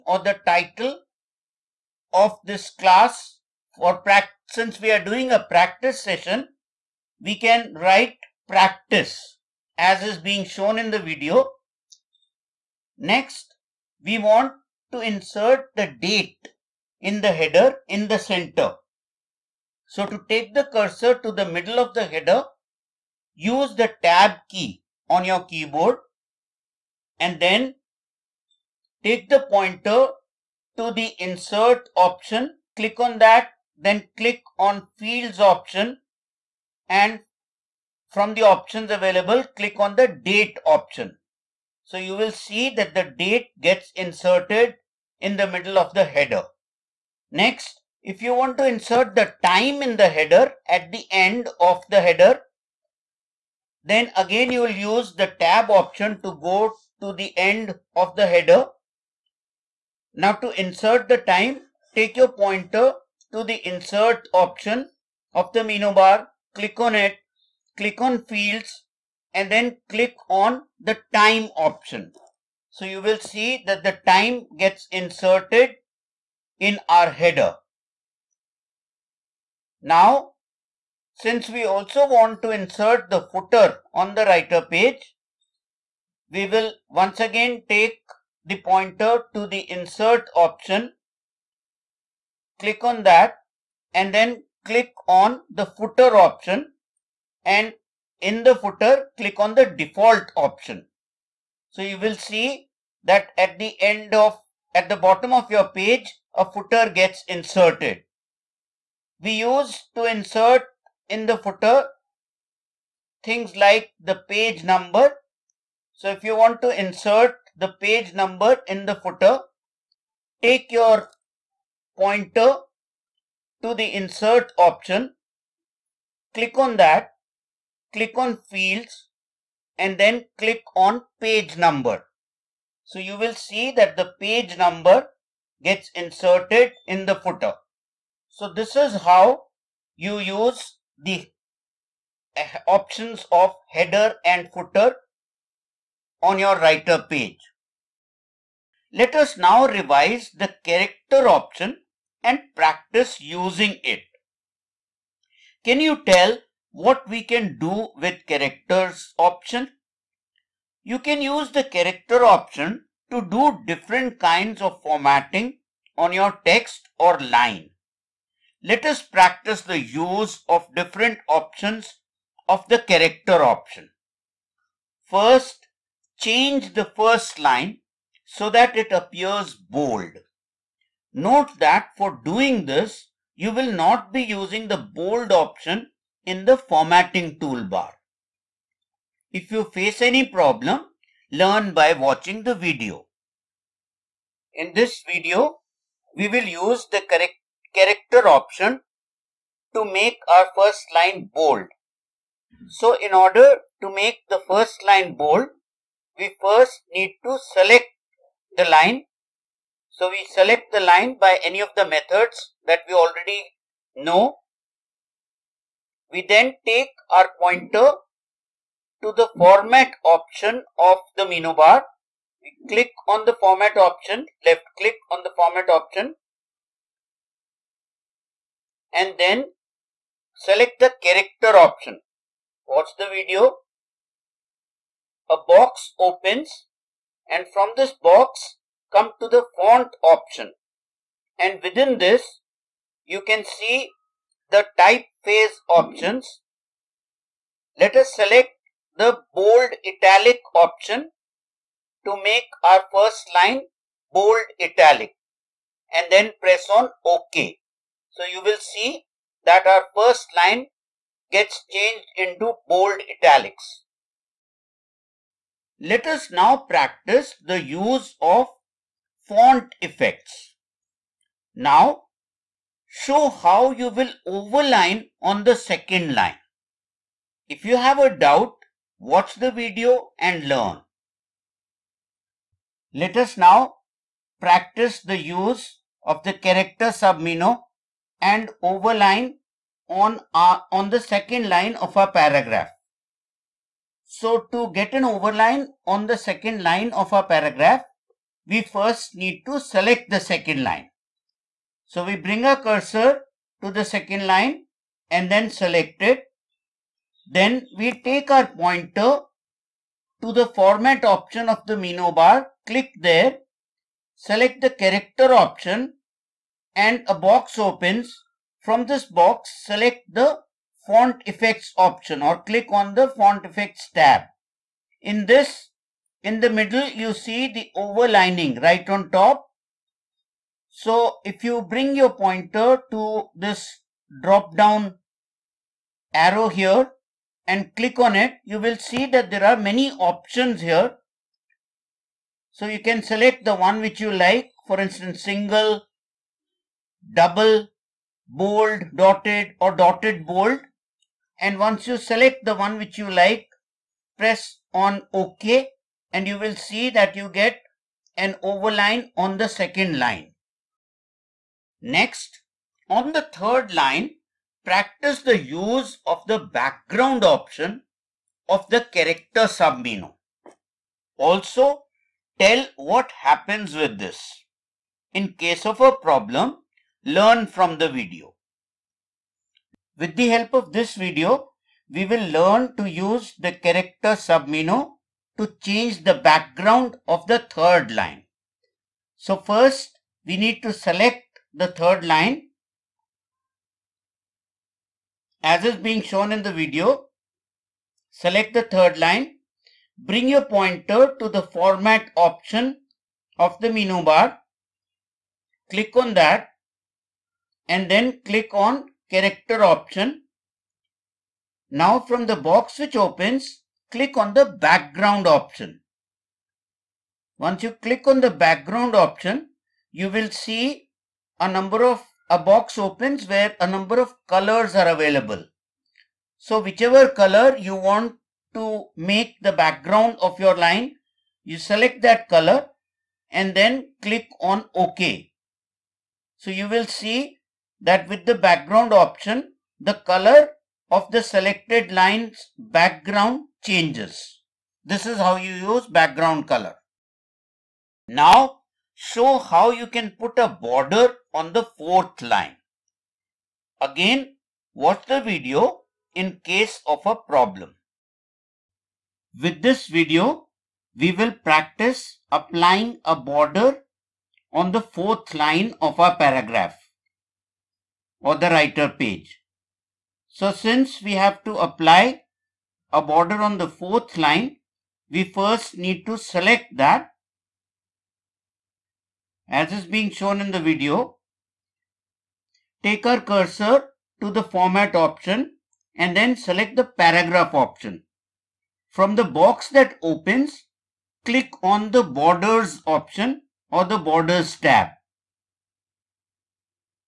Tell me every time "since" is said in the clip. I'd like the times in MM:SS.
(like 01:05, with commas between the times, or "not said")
00:04, 01:21, 07:50.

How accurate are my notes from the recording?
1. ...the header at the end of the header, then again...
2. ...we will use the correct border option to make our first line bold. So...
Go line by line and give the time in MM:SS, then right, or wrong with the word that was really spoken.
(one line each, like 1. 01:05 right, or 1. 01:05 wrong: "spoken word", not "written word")
1. 00:49 right
2. 03:16 wrong: "character", not "border".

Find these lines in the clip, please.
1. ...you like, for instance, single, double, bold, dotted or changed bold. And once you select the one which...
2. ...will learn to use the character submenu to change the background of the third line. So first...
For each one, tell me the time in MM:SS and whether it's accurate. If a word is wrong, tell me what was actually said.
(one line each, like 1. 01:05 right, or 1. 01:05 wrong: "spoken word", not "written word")
1. 05:43 wrong: "dotted", not "changed"
2. 06:22 right.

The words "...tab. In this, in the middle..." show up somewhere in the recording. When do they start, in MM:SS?
05:23.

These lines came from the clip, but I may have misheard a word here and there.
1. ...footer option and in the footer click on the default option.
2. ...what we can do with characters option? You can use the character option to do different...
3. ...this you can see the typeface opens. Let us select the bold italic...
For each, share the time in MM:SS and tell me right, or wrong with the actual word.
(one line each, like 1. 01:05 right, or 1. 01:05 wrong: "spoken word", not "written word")
1. 01:35 right
2. 02:36 right
3. 04:01 wrong: "options", not "opens".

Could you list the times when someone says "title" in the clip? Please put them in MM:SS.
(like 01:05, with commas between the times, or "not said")
00:00.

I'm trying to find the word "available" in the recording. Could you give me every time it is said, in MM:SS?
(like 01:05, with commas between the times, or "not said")
00:38, 07:04.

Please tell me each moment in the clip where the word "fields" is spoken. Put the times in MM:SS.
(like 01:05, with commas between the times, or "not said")
00:34, 01:08, 02:08.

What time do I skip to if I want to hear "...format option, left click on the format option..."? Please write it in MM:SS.
03:43.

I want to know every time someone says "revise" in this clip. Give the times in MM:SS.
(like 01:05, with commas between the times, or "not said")
02:29.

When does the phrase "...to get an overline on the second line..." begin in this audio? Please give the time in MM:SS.
04:54.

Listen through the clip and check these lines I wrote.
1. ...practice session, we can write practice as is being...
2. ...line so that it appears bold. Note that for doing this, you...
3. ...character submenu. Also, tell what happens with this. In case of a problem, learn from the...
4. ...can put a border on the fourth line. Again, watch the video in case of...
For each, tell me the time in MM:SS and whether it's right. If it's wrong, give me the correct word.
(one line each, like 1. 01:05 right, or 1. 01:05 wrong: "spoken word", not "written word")
1. 00:05 right
2. 02:57 right
3. 06:08 right
4. 07:29 right.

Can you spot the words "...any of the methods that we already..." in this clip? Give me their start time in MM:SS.
03:31.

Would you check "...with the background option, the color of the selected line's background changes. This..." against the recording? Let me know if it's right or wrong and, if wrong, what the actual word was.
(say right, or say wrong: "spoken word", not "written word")
right.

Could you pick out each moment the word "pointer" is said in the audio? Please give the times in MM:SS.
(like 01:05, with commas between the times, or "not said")
00:29, 01:02, 01:28, 02:01, 03:37, 05:08, 05:32, 06:40.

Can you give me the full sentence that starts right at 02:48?
Let us practice the use of different options of the character option.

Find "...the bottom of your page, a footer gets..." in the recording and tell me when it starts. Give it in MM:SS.
01:44.